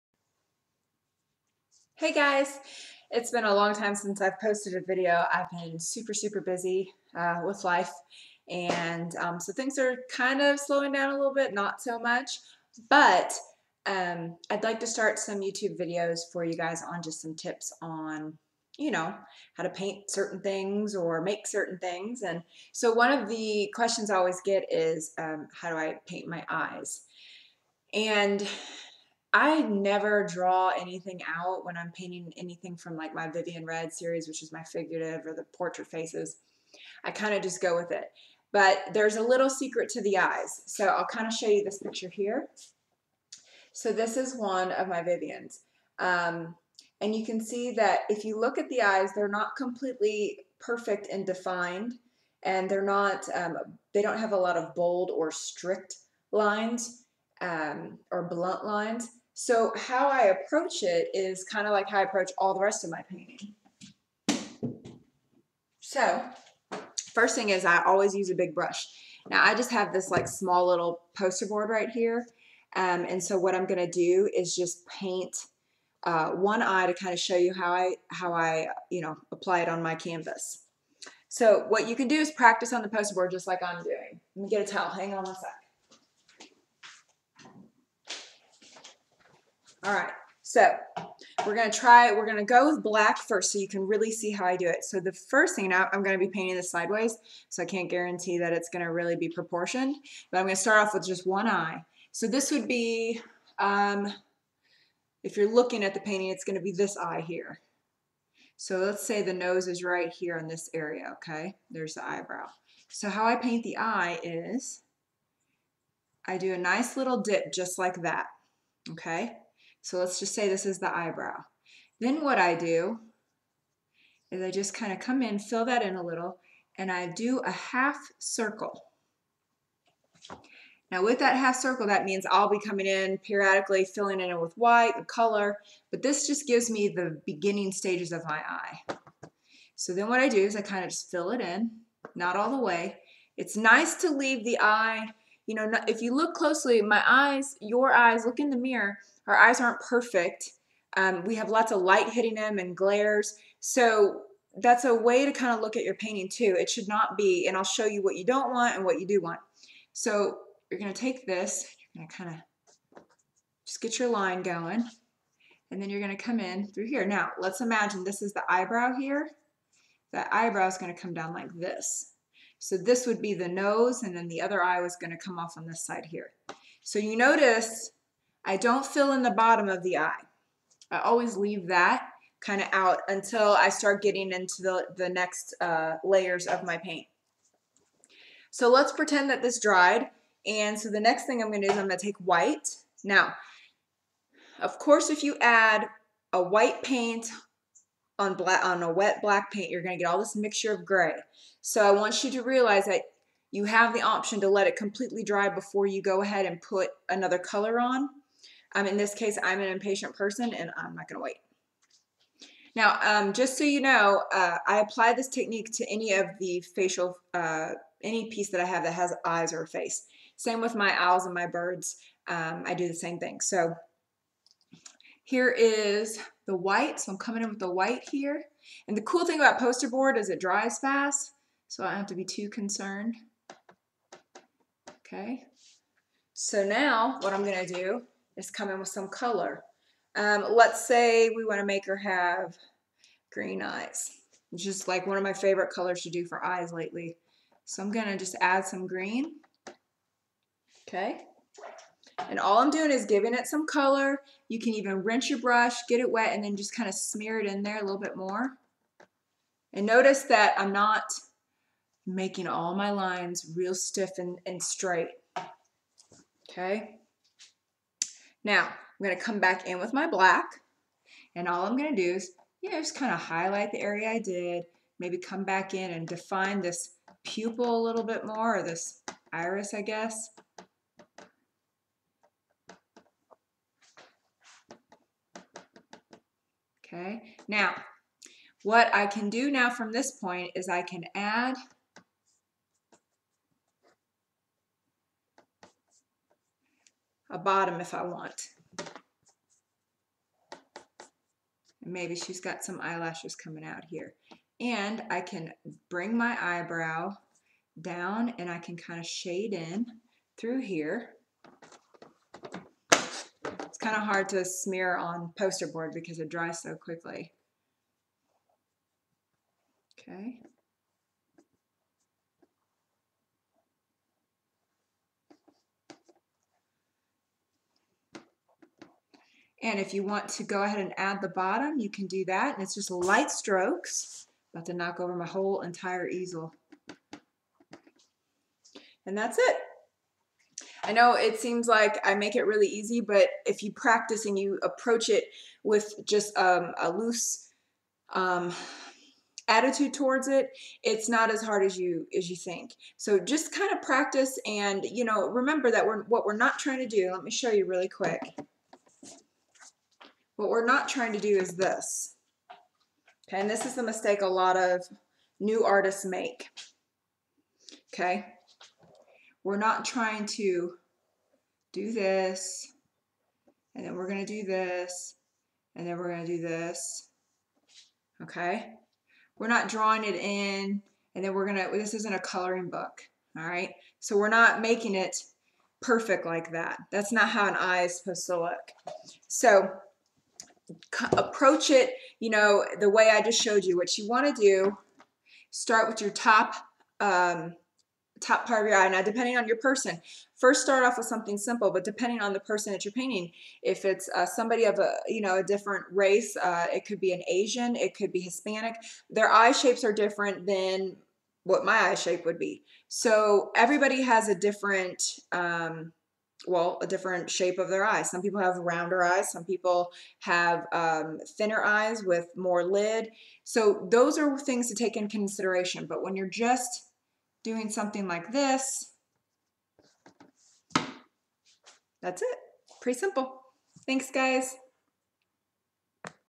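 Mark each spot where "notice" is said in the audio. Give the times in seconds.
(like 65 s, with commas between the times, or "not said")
177 s, 259 s.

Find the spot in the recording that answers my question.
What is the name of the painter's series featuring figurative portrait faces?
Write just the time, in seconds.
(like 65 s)
33 s.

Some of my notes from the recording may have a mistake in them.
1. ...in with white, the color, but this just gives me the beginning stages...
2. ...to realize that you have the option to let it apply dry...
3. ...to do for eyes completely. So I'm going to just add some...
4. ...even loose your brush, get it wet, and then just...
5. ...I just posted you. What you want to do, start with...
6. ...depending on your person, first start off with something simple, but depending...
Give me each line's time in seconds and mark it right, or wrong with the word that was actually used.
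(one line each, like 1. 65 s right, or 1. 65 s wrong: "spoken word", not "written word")
1. 134 s right
2. 202 s wrong: "completely", not "apply"
3. 246 s wrong: "lately", not "completely"
4. 254 s wrong: "rinse", not "loose"
5. 393 s wrong: "showed", not "posted"
6. 399 s right.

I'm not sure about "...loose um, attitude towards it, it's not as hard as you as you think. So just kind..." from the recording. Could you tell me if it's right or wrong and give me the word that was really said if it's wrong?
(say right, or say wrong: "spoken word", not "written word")
right.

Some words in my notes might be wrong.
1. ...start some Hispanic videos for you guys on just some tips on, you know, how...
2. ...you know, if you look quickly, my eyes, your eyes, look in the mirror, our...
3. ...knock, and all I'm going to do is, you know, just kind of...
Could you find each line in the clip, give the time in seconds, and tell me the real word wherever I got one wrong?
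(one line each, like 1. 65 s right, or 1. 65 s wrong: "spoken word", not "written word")
1. 14 s wrong: "YouTube", not "Hispanic"
2. 145 s wrong: "closely", not "quickly"
3. 270 s wrong: "black", not "knock".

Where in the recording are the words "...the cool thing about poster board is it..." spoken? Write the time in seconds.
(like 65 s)
228 s.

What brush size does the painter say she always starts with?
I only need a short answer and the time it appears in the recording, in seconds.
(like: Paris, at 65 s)
big brush, at 68 s.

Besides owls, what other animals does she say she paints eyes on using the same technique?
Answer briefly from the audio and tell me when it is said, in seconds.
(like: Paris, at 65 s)
birds, at 221 s.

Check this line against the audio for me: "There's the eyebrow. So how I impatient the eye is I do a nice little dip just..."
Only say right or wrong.
wrong.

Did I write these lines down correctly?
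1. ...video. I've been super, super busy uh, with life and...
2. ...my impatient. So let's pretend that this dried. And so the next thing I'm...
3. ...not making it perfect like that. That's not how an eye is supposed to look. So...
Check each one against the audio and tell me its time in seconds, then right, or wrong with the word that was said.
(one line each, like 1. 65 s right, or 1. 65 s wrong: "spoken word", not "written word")
1. 4 s right
2. 186 s wrong: "paint", not "impatient"
3. 384 s right.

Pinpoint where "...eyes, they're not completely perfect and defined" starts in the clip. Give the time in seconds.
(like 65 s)
48 s.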